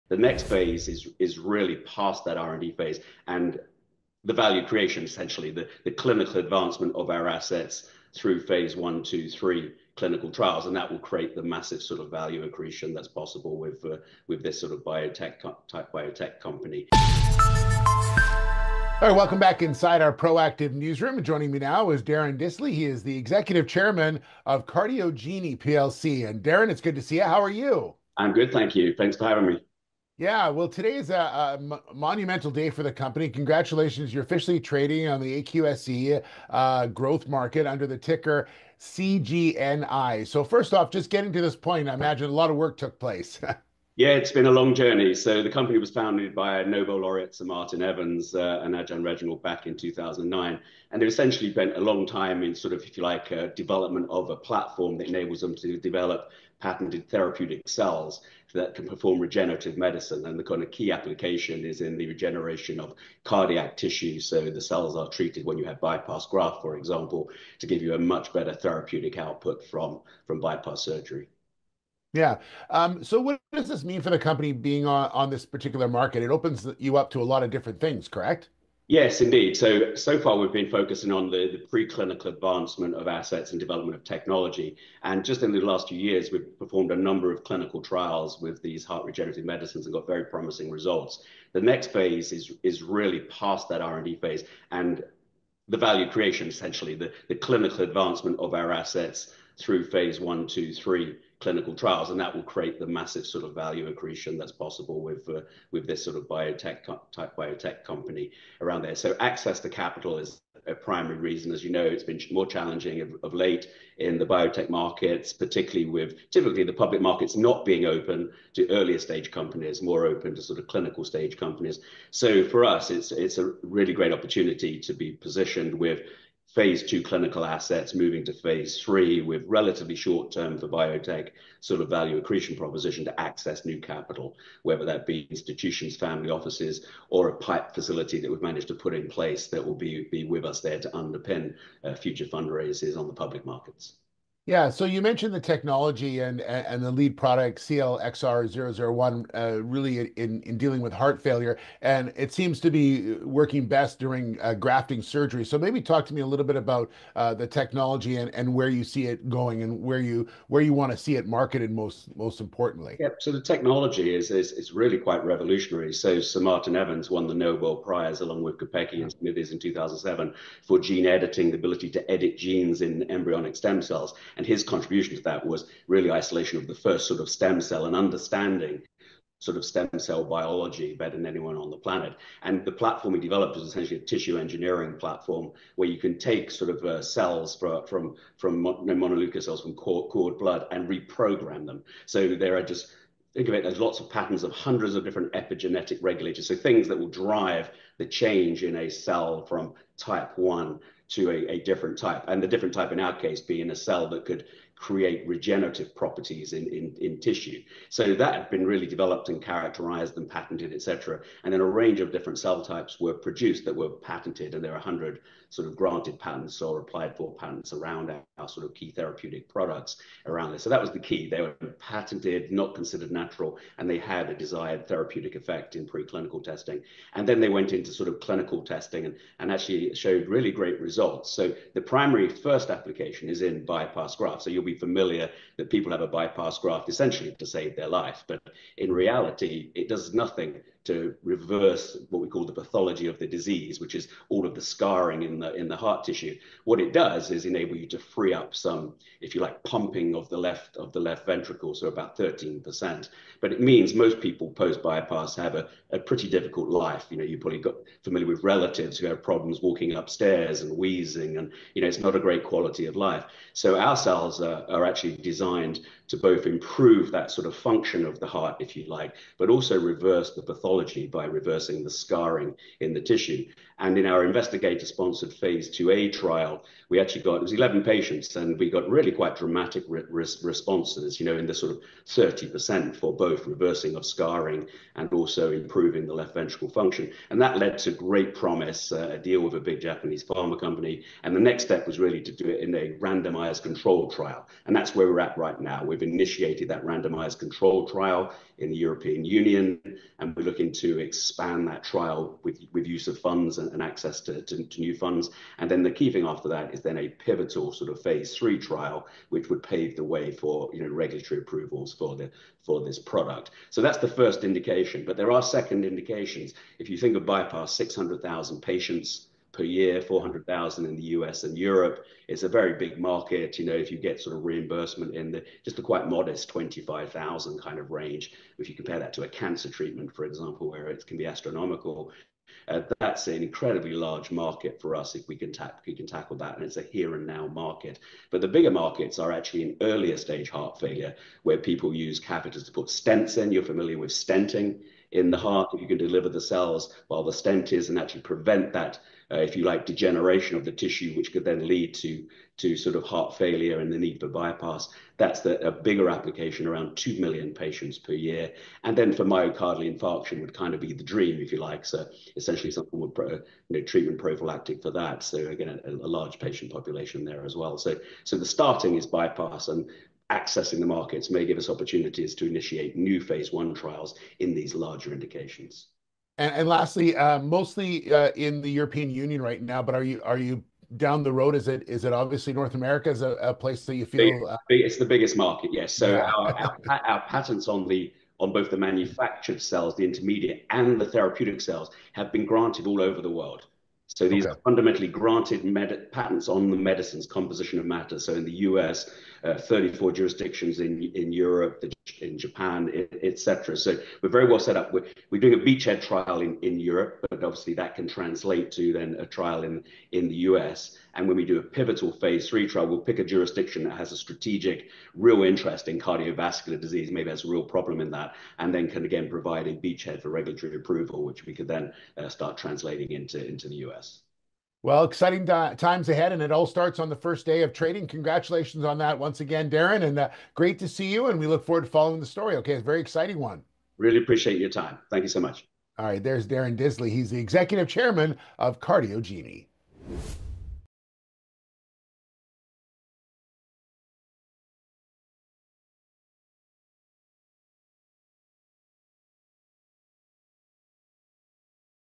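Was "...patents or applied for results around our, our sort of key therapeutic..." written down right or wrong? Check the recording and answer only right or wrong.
wrong.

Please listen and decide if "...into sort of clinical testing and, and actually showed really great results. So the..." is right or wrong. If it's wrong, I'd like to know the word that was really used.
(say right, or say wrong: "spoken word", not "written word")
right.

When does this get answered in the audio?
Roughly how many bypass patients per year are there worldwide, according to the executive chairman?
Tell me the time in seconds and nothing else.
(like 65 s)
317 s.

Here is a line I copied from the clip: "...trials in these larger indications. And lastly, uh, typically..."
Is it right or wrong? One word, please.
wrong.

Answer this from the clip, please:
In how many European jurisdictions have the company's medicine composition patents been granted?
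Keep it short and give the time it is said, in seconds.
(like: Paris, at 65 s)
34, at 399 s.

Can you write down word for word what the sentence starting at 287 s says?
And that led to great promise, uh, a deal with a big Japanese pharma company.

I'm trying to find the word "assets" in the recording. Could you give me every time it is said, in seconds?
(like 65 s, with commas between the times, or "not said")
7 s, 83 s, 98 s, 127 s.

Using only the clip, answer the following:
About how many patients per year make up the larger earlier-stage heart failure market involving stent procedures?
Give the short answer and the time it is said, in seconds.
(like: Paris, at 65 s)
2 million, at 356 s.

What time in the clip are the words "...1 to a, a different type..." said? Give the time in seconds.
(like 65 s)
200 s.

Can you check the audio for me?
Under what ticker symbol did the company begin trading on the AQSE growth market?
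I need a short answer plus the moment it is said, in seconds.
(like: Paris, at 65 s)
CGNI, at 38 s.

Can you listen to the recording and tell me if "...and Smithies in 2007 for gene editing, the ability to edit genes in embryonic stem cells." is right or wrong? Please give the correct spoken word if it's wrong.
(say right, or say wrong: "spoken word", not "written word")
right.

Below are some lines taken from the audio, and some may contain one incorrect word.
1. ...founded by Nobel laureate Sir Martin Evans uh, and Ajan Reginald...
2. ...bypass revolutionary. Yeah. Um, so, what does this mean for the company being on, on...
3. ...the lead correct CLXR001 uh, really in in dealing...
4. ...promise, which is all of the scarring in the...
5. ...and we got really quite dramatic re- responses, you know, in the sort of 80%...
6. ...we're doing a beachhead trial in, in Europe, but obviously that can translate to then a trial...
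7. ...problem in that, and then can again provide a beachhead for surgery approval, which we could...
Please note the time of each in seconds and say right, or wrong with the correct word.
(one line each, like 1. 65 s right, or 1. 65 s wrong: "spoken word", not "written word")
1. 45 s right
2. 70 s wrong: "surgery", not "revolutionary"
3. 146 s wrong: "product", not "correct"
4. 243 s wrong: "disease", not "promise"
5. 278 s wrong: "30", not "80"
6. 405 s right
7. 417 s wrong: "regulatory", not "surgery".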